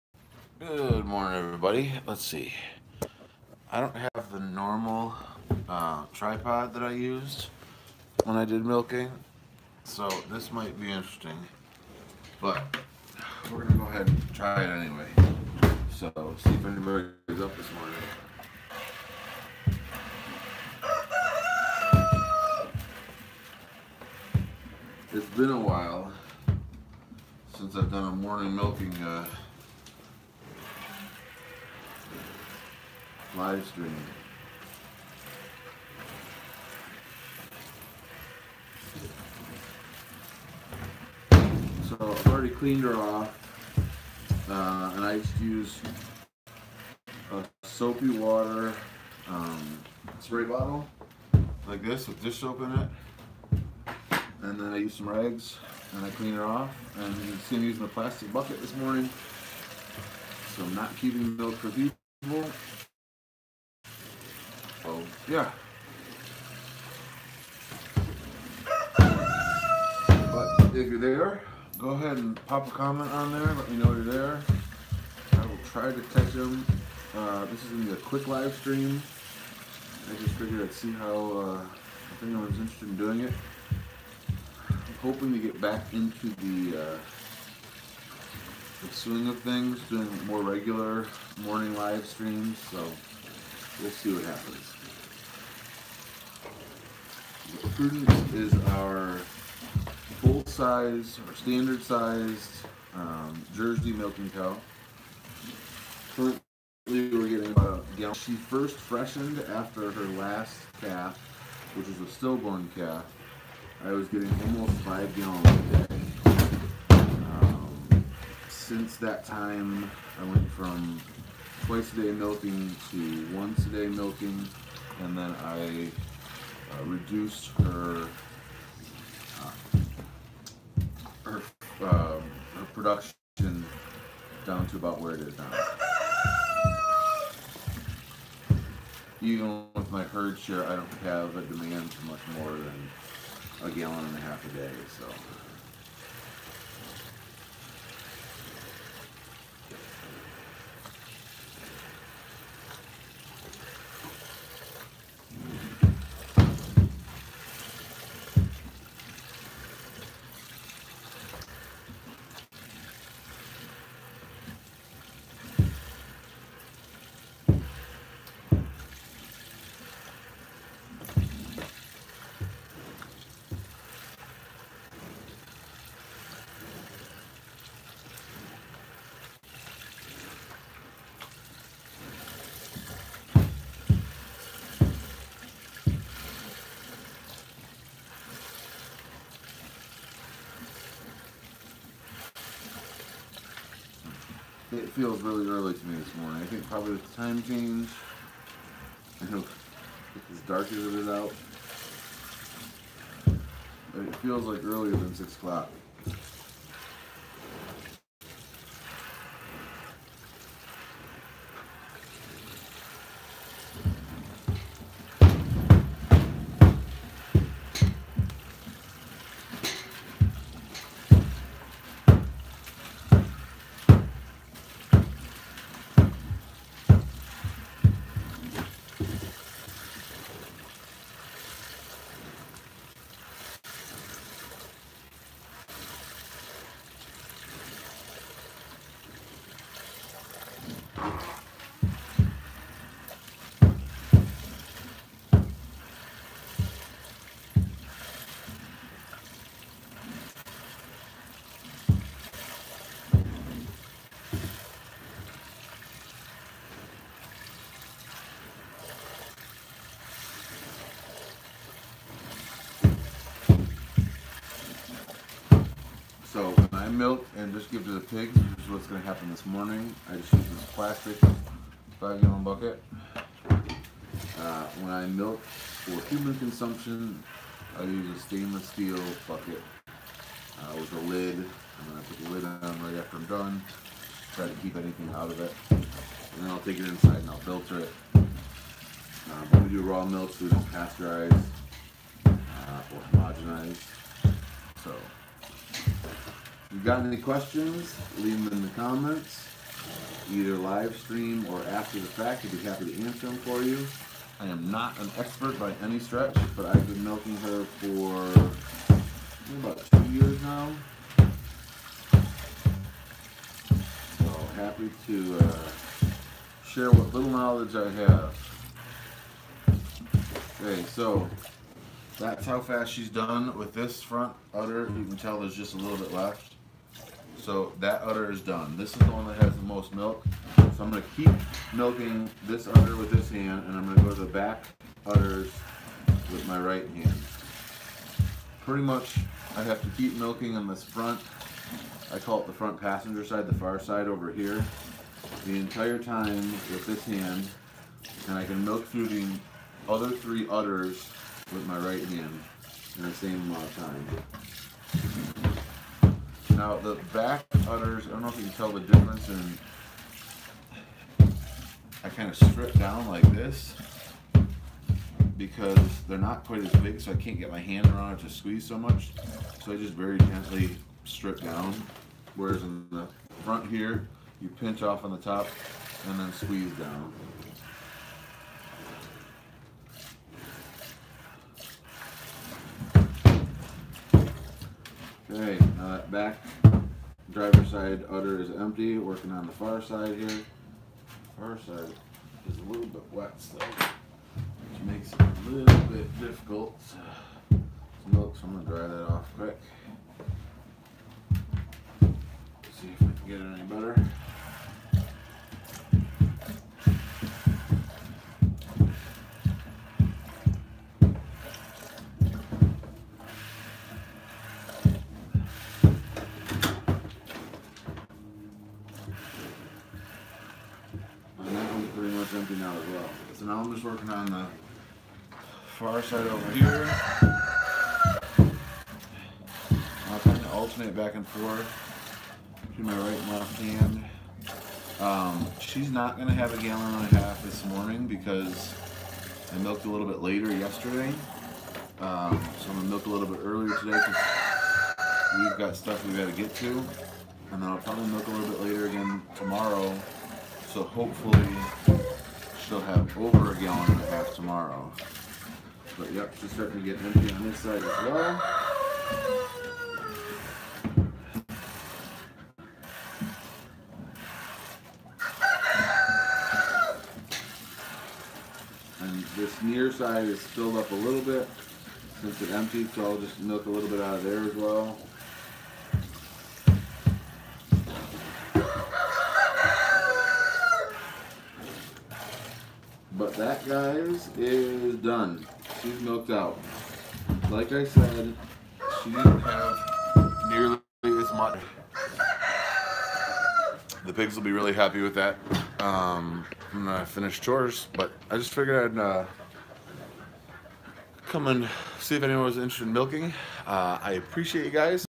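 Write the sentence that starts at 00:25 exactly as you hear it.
It's been a while since I've done a morning milking uh, live stream.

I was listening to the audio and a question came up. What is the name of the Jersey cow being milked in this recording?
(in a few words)
Prudence.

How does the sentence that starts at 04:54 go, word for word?
So if you've got any questions, leave them in the comments, either live stream or after the fact.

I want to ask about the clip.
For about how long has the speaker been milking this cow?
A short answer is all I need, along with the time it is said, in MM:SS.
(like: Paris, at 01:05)
About 2 years, at 05:09.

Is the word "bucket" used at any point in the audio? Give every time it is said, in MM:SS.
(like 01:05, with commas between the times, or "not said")
00:58, 04:32, 04:39.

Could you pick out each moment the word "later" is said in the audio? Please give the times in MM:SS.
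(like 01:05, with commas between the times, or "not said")
07:20, 07:28.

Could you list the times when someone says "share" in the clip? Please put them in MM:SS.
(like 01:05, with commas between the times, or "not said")
02:20, 05:16.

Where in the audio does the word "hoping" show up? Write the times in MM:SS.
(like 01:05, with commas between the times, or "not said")
01:25.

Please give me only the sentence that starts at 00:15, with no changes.
So, see if anybody is up this morning.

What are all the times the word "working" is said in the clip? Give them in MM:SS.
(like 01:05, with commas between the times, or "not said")
06:28, 07:03.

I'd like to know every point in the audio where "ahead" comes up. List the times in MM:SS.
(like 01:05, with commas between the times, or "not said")
00:13, 01:11.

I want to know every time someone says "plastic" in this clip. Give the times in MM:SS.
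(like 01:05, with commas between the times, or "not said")
00:57, 04:30.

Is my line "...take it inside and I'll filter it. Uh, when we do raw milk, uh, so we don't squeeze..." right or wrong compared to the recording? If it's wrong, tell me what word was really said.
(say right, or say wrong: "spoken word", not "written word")
wrong: "pasteurize", not "squeeze".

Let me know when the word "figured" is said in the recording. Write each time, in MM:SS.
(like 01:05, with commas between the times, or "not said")
01:20, 08:18.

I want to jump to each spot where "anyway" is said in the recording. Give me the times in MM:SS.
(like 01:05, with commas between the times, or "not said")
00:14.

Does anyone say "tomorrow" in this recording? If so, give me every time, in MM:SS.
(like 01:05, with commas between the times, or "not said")
07:29, 07:34.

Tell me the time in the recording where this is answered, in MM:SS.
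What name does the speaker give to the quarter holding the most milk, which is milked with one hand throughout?
05:42.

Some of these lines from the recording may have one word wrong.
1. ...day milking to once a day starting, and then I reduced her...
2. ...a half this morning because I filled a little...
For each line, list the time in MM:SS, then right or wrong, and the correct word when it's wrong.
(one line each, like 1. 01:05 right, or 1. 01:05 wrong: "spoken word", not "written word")
1. 02:01 wrong: "milking", not "starting"
2. 07:17 wrong: "milked", not "filled".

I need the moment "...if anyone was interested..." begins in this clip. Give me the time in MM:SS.
08:22.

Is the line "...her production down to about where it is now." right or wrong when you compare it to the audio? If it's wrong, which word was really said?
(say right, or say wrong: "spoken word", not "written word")
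right.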